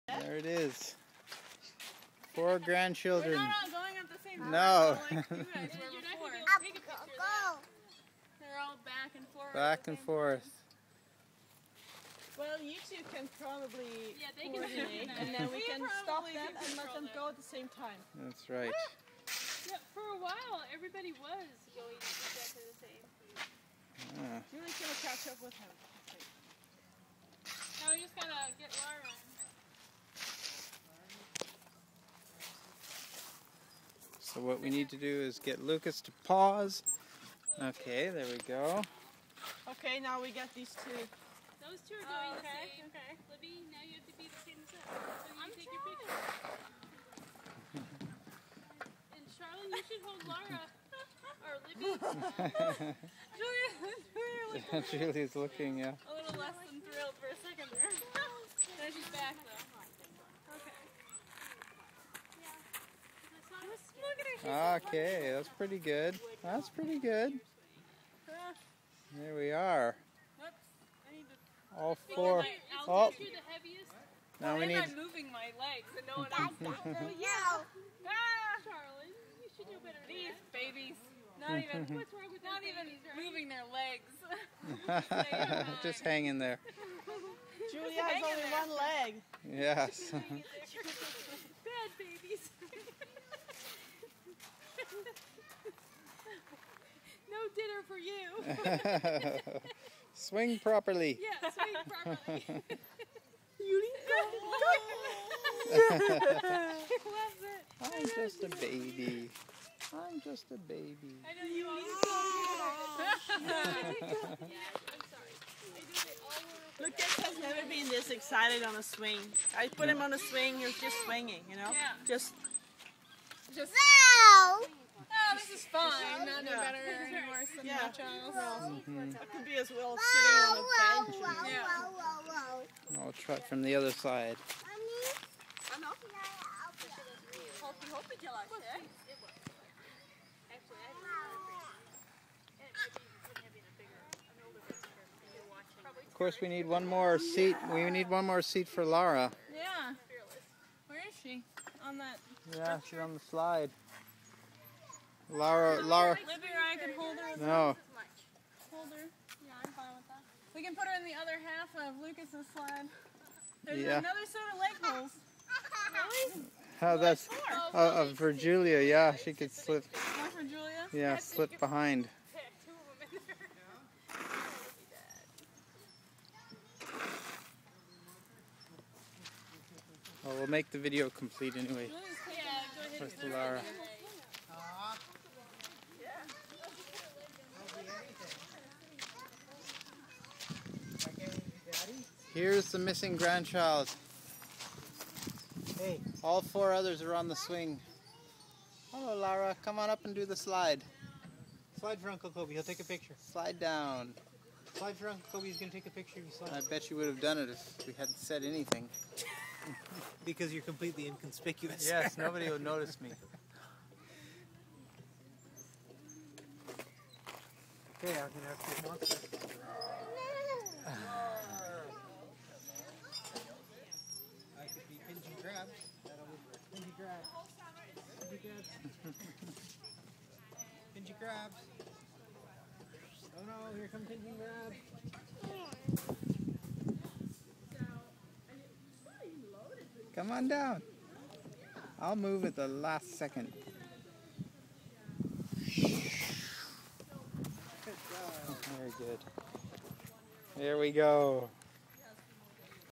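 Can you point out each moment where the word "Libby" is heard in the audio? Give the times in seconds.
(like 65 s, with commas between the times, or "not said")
43 s, 51 s, 156 s.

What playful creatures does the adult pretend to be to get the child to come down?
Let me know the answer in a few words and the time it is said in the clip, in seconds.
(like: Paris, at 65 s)
Pinchy crabs, at 234 s.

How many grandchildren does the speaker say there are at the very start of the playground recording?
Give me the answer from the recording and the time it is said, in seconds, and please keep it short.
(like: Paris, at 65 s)
4, at 2 s.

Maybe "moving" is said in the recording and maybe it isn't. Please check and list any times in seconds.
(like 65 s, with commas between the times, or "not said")
74 s, 83 s.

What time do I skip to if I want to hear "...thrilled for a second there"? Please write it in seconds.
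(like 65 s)
56 s.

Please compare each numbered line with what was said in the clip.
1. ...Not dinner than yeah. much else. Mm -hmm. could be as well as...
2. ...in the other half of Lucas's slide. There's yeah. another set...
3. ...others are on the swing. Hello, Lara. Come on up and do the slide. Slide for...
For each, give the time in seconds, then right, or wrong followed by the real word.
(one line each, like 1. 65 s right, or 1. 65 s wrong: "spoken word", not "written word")
1. 125 s wrong: "better", not "dinner"
2. 160 s right
3. 196 s right.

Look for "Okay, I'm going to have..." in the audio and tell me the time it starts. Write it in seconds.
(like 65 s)
218 s.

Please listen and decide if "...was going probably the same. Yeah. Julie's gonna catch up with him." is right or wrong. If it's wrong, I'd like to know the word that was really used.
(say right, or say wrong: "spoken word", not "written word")
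wrong: "exactly", not "probably".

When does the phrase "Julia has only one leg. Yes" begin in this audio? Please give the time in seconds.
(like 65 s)
87 s.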